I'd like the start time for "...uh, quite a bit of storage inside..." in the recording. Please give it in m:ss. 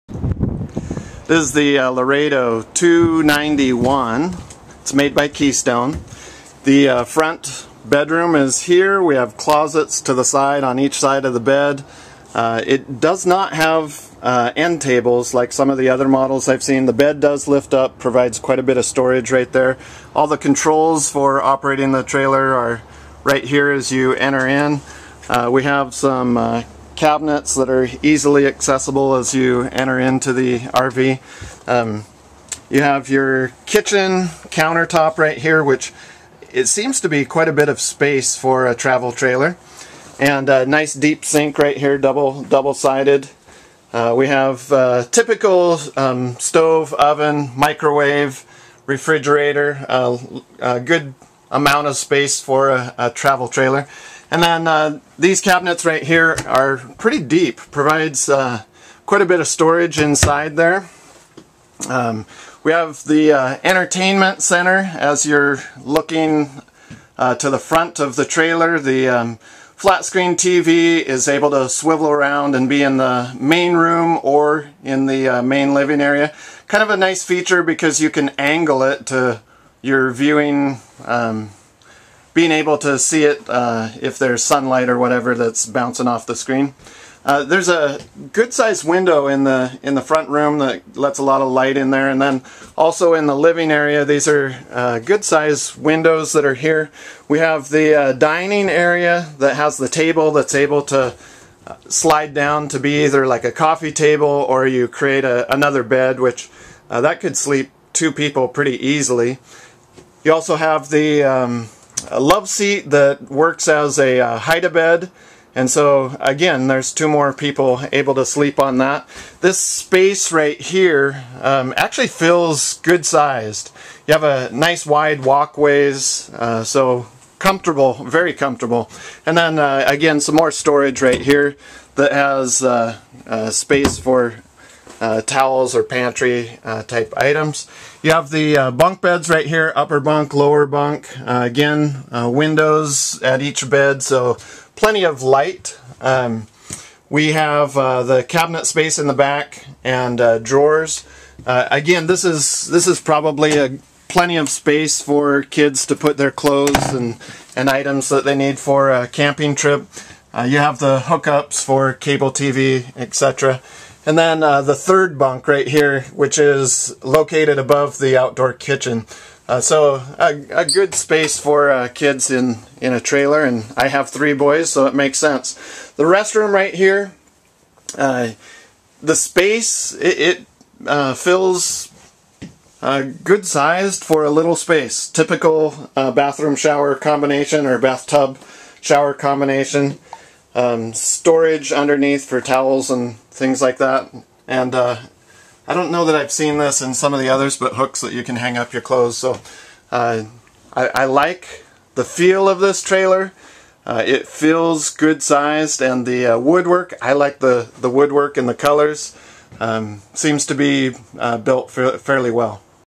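0:58.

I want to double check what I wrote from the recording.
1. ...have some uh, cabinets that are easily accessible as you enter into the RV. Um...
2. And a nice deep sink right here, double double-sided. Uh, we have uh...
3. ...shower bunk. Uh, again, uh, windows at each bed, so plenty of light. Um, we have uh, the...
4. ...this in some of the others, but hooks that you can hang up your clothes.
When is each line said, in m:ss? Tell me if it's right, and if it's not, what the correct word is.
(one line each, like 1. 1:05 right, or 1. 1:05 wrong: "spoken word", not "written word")
1. 0:25 right
2. 0:40 right
3. 2:20 wrong: "lower", not "shower"
4. 3:16 right.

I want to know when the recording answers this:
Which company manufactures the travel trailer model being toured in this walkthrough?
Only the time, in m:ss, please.
0:05.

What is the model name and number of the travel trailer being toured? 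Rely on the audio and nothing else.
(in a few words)
Laredo 291.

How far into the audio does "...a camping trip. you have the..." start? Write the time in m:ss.
2:38.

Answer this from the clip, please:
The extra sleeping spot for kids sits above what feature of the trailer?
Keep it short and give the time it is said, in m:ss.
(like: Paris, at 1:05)
outdoor kitchen, at 2:48.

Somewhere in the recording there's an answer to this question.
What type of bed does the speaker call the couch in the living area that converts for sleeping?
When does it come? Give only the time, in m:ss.
1:54.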